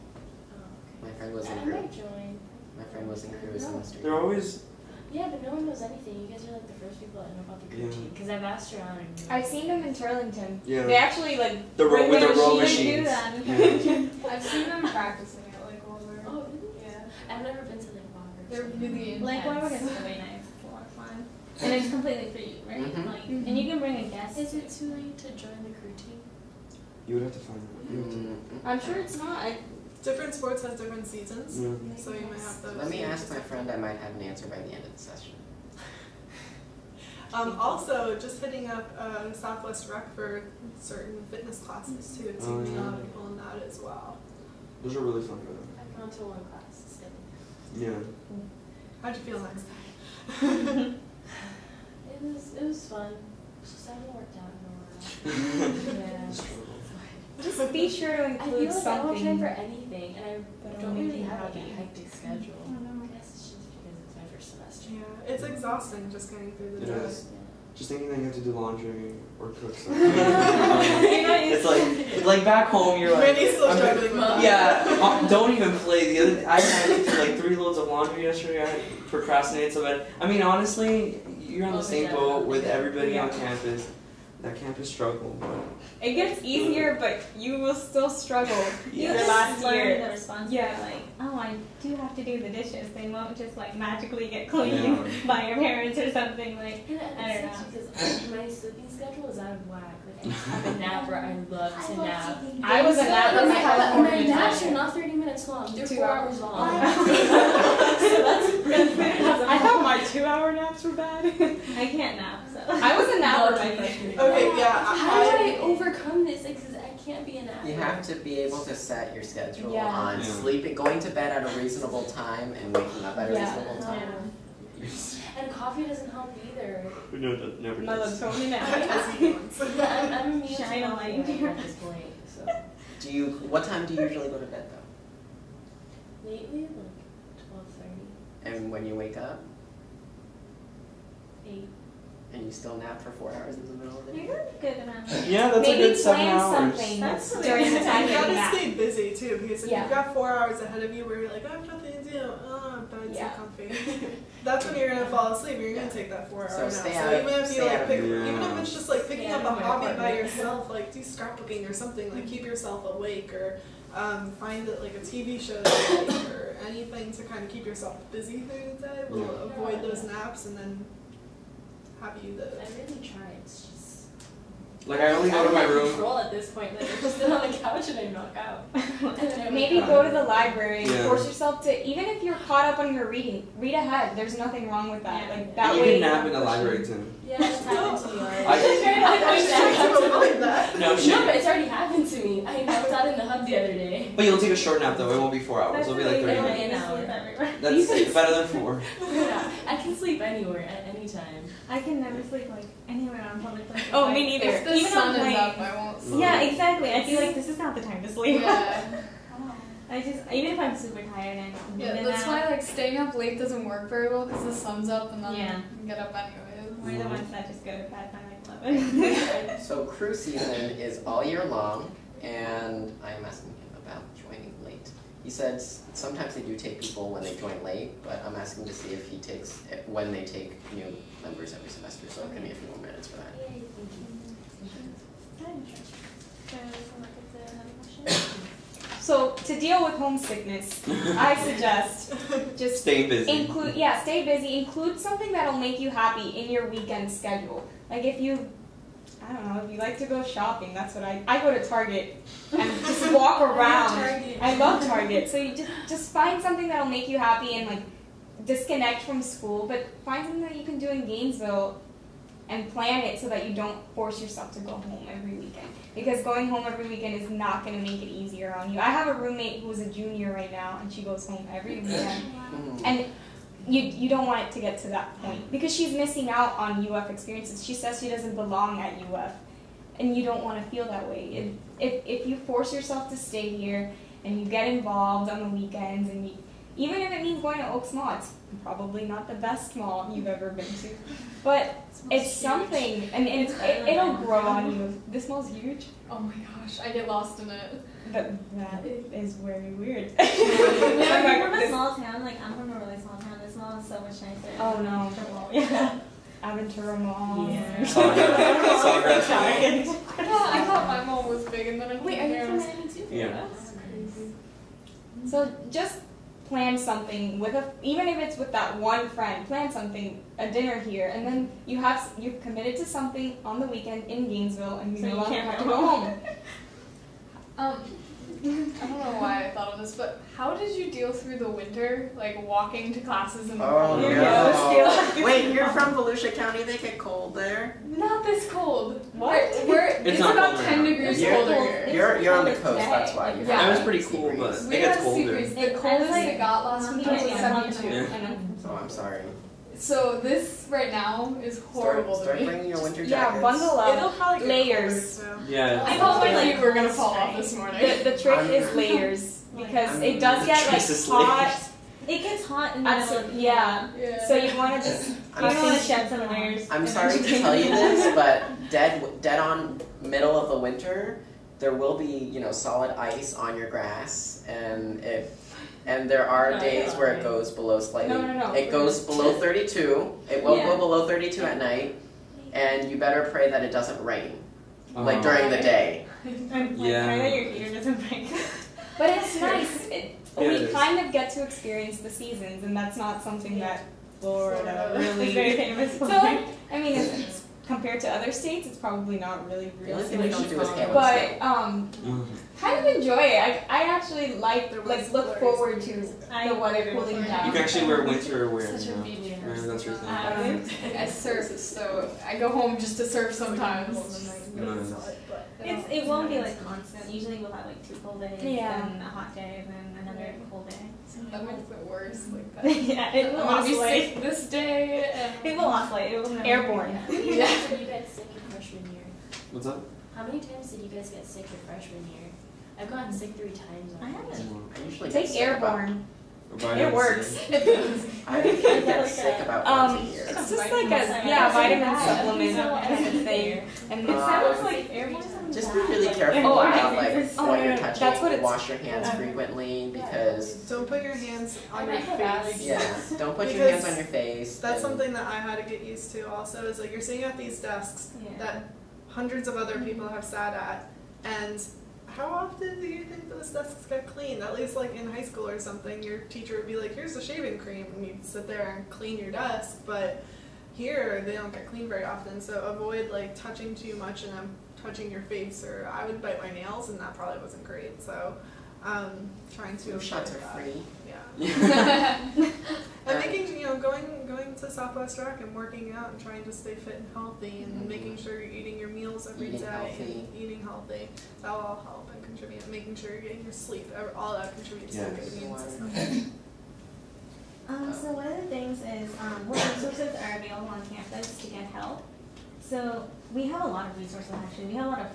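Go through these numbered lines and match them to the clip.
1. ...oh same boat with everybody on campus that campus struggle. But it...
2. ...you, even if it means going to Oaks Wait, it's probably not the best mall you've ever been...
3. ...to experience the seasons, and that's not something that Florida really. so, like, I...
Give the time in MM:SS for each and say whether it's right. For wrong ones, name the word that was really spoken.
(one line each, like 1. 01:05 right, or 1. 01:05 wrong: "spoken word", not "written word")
1. 01:21 right
2. 04:46 wrong: "Mall", not "Wait"
3. 06:31 right.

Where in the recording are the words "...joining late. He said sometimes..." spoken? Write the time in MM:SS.
03:44.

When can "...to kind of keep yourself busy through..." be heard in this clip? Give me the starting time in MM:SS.
02:47.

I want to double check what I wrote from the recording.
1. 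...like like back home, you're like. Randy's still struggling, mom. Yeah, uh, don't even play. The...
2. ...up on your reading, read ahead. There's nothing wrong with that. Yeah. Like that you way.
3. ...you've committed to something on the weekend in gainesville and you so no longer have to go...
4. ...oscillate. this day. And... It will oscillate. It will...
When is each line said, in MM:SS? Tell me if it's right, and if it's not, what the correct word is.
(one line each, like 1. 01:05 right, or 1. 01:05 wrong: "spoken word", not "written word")
1. 01:11 right
2. 03:02 right
3. 05:22 right
4. 07:03 right.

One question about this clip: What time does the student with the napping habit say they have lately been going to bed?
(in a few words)
12:30.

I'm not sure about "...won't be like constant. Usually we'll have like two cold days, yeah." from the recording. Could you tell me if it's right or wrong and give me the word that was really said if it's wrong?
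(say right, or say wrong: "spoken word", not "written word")
right.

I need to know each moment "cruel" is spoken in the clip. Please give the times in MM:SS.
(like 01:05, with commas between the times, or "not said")
not said.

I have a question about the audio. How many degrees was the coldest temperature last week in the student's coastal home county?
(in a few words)
72.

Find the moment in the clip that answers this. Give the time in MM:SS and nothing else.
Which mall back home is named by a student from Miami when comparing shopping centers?
05:06.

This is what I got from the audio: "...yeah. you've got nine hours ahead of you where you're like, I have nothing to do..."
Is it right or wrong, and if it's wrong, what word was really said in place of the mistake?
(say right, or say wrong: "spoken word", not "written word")
wrong: "four", not "nine".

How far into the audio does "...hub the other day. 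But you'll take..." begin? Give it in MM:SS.
03:13.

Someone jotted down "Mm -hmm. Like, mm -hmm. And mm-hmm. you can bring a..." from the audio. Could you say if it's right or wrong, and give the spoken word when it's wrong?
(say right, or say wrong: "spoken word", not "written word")
right.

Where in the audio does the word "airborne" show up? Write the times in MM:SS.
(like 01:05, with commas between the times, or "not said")
07:06, 07:15.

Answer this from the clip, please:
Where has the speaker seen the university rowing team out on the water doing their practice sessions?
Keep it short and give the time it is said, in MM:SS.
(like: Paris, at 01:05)
Lake Wauburg, at 00:15.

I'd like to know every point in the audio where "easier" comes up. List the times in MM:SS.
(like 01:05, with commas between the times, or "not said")
01:26, 04:28.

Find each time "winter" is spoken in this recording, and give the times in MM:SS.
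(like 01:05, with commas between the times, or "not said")
05:31, 05:52, 06:10, 06:48.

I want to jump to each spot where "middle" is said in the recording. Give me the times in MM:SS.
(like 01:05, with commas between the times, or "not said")
02:23, 06:02, 06:10.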